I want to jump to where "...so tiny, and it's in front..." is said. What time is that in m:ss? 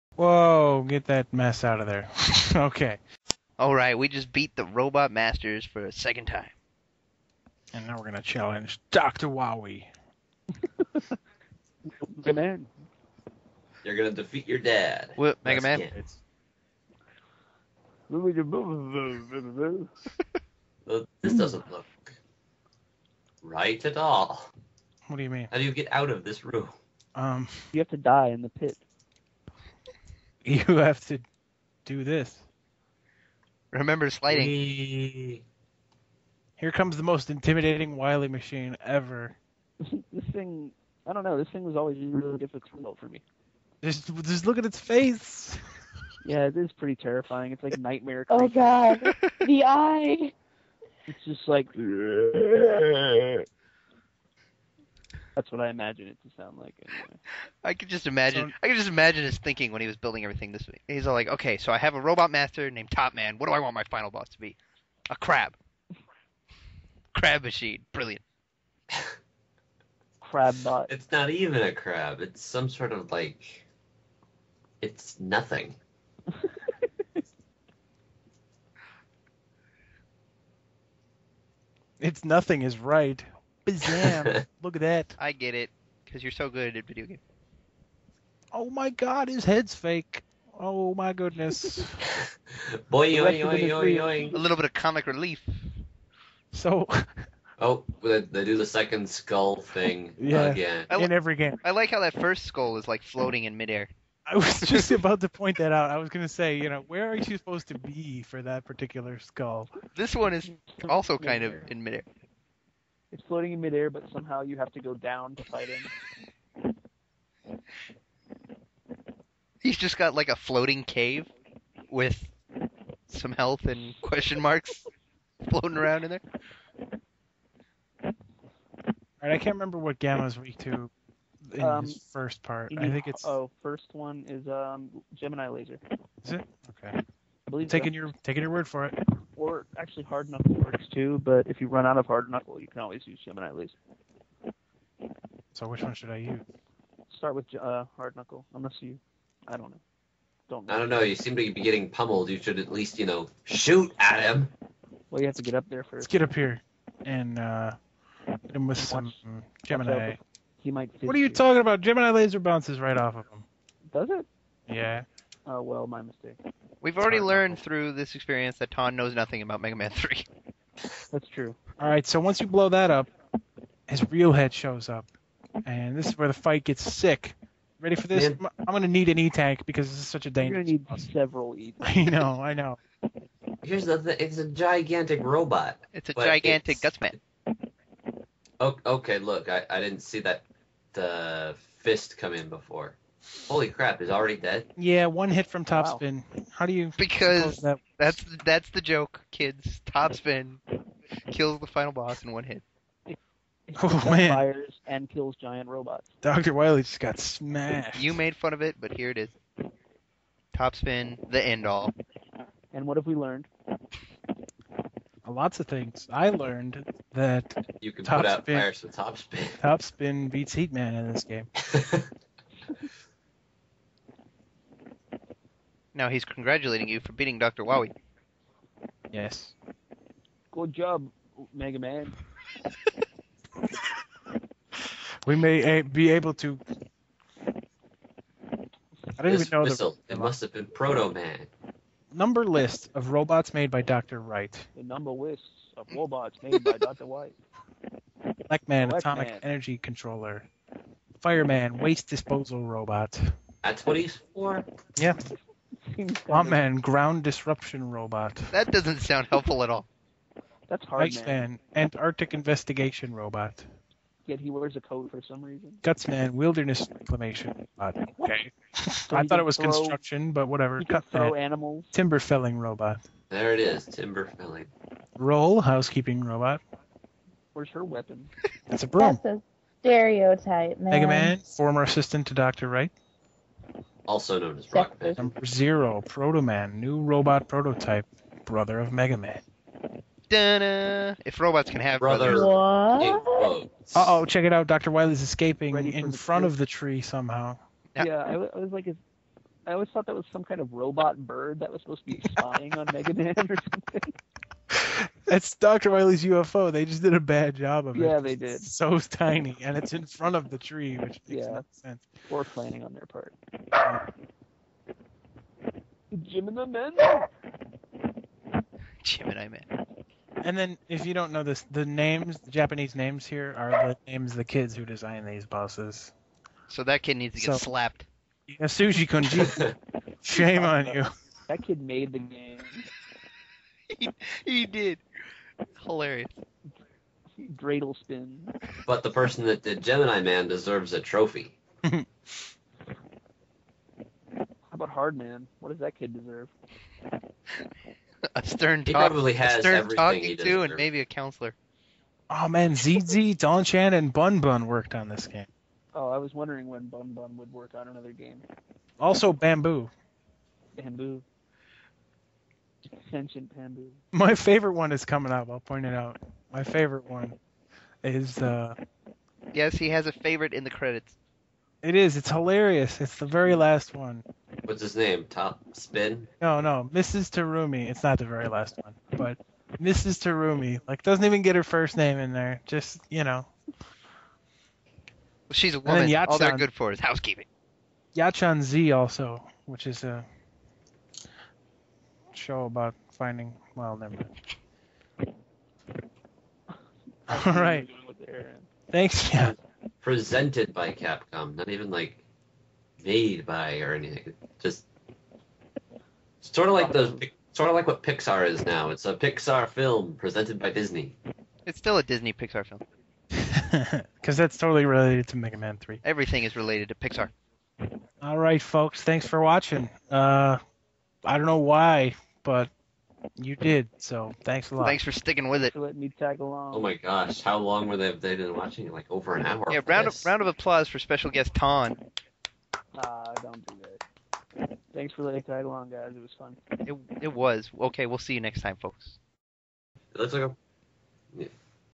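5:08.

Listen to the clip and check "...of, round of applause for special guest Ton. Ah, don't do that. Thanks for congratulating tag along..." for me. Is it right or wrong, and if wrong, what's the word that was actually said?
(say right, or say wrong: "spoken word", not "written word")
wrong: "letting", not "congratulating".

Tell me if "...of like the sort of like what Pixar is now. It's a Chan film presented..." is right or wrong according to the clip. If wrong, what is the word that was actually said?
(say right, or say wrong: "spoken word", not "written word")
wrong: "Pixar", not "Chan".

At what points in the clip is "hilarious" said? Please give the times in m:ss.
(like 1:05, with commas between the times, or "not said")
5:35, 6:12.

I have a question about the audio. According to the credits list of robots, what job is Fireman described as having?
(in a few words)
Waste Disposal Robot.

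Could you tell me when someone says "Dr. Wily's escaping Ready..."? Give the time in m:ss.
4:54.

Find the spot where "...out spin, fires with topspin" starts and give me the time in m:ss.
3:38.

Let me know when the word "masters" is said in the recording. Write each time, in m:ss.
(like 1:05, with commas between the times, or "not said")
0:05, 1:02.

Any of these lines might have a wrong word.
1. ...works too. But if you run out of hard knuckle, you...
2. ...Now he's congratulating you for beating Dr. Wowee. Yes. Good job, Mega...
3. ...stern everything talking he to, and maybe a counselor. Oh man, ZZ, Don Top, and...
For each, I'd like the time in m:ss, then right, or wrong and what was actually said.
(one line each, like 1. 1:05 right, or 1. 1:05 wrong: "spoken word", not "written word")
1. 2:20 right
2. 3:46 right
3. 5:49 wrong: "Chan", not "Top".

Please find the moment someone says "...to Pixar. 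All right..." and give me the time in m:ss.
6:56.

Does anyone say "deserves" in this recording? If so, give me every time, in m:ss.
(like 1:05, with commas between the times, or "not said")
5:40, 5:46.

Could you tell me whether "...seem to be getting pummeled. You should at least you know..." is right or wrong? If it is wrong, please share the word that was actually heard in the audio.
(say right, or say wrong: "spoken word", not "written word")
right.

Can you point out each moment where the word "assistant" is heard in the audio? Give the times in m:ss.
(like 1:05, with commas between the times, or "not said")
4:41.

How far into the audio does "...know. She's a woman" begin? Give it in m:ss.
6:23.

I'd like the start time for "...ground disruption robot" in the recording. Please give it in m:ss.
4:16.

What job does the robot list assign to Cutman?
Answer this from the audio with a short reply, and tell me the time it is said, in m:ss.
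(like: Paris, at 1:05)
Timber felling robot, at 4:31.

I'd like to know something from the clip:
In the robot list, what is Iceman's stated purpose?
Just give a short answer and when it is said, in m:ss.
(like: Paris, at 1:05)
Antarctic investigation robot, at 4:21.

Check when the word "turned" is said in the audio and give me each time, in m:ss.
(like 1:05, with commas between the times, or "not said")
not said.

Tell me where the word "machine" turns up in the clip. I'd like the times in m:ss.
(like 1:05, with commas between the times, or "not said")
0:38, 1:07.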